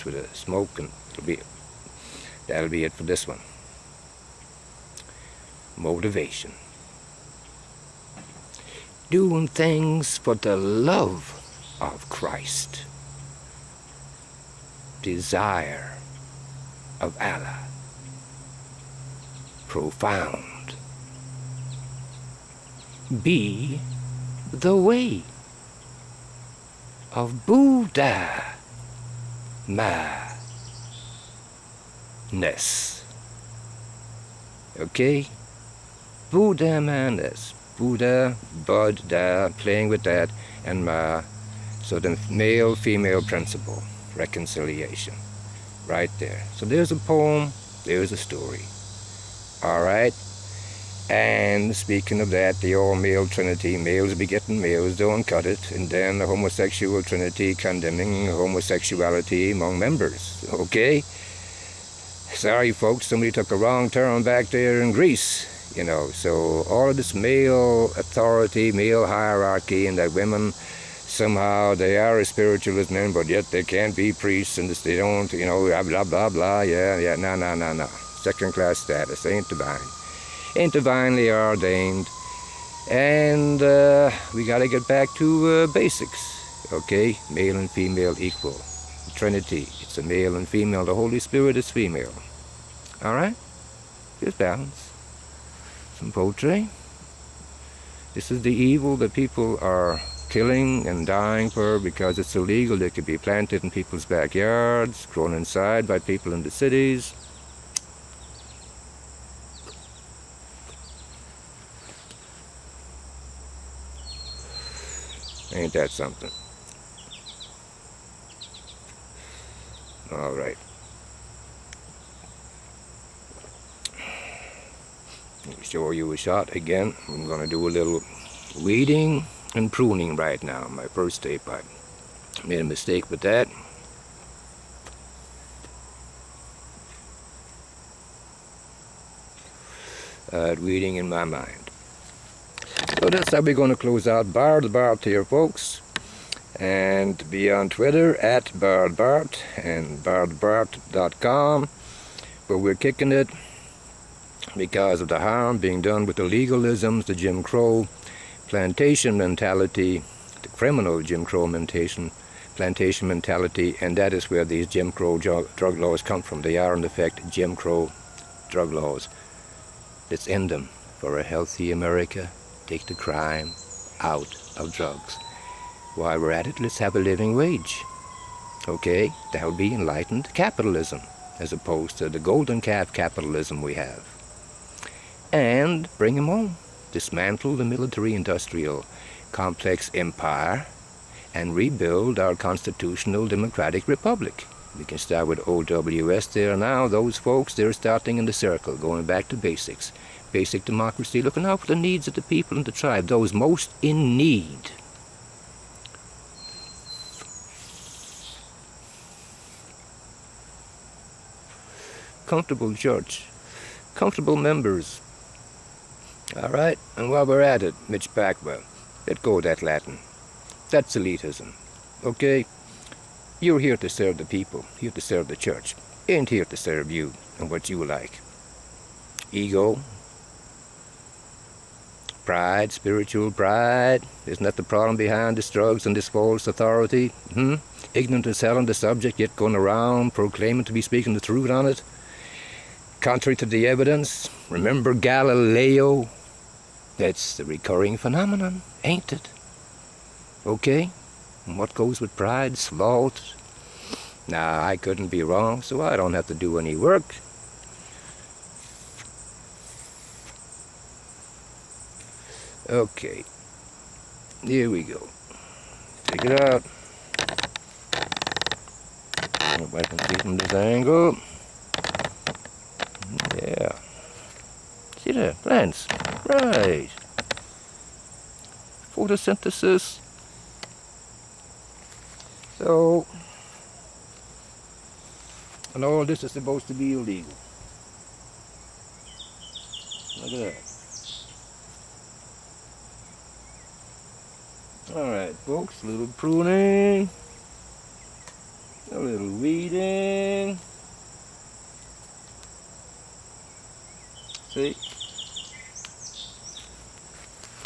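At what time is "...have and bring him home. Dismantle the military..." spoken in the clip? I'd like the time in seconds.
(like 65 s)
183 s.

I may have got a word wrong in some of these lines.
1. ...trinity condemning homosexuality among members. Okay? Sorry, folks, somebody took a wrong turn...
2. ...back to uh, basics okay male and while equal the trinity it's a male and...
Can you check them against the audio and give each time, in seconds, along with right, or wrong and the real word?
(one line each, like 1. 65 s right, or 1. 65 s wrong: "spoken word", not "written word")
1. 57 s right
2. 84 s wrong: "female", not "while".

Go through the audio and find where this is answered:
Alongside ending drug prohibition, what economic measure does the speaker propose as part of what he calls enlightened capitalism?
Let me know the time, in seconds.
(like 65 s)
176 s.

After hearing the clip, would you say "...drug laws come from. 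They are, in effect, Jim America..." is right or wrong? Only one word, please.
wrong.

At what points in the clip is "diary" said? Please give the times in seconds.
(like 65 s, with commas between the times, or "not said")
not said.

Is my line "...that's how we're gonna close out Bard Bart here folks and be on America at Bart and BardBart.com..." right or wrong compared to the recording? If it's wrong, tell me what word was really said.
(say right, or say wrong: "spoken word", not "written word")
wrong: "Twitter", not "America".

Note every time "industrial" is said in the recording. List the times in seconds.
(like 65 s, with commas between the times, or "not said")
188 s.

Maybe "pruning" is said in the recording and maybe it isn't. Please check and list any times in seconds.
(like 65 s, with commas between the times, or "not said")
129 s, 296 s.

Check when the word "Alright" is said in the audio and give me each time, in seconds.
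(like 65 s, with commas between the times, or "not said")
49 s, 294 s.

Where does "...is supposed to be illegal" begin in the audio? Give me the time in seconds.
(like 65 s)
286 s.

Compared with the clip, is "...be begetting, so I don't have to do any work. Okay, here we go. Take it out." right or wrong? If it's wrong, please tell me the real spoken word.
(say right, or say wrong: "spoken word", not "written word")
wrong: "wrong", not "begetting".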